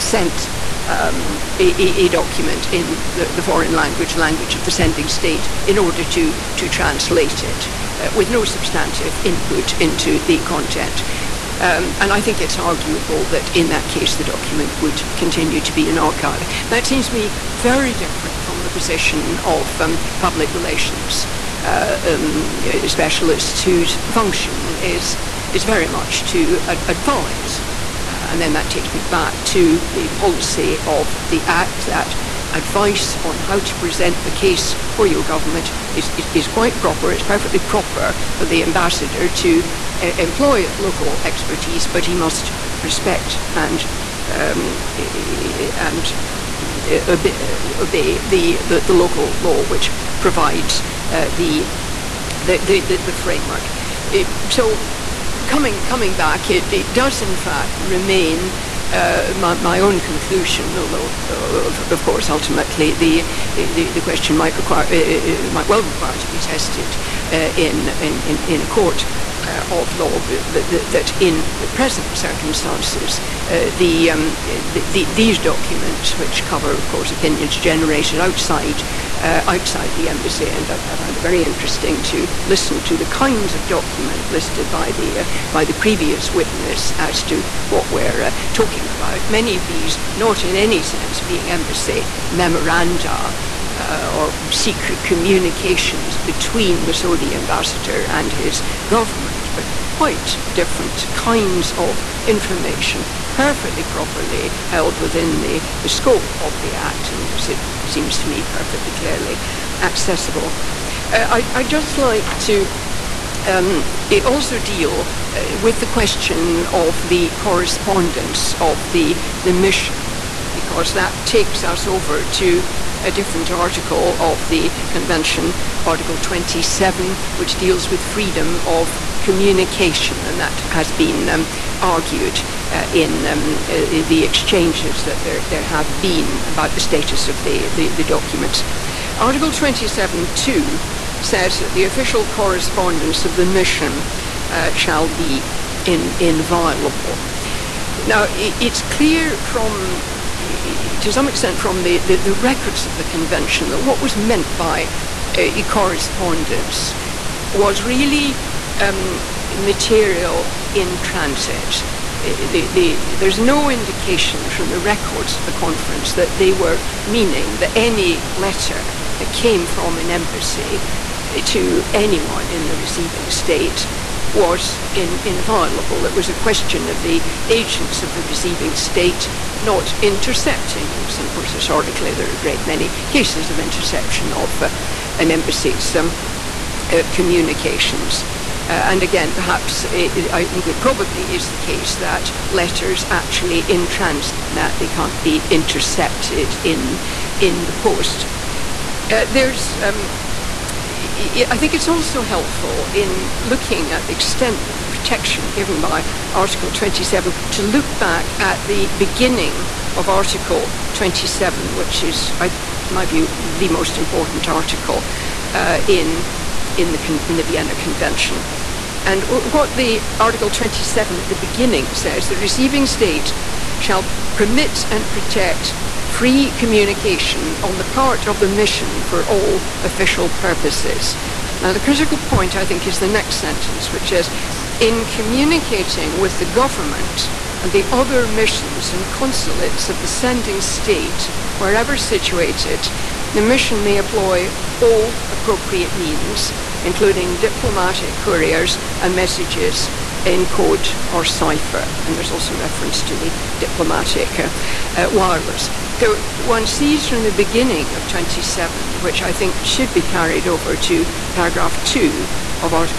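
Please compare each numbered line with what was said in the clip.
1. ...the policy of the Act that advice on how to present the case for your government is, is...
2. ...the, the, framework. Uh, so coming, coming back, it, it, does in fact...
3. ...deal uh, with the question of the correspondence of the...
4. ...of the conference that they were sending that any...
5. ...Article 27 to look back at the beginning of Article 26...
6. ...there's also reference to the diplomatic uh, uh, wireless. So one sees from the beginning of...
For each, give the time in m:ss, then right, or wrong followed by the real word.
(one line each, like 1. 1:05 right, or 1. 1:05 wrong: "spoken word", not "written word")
1. 0:29 right
2. 0:52 right
3. 1:54 right
4. 2:45 wrong: "meaning", not "sending"
5. 3:26 wrong: "27", not "26"
6. 4:12 right.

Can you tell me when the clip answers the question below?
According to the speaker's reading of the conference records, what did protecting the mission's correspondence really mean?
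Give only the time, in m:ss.
2:39.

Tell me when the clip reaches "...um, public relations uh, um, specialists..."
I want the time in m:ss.
0:19.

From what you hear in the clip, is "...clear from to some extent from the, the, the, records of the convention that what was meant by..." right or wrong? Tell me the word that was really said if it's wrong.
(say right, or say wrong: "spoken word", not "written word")
right.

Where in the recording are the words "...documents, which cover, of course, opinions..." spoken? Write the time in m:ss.
1:15.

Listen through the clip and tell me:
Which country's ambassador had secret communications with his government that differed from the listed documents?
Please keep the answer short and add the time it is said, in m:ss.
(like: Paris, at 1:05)
Saudi, at 1:36.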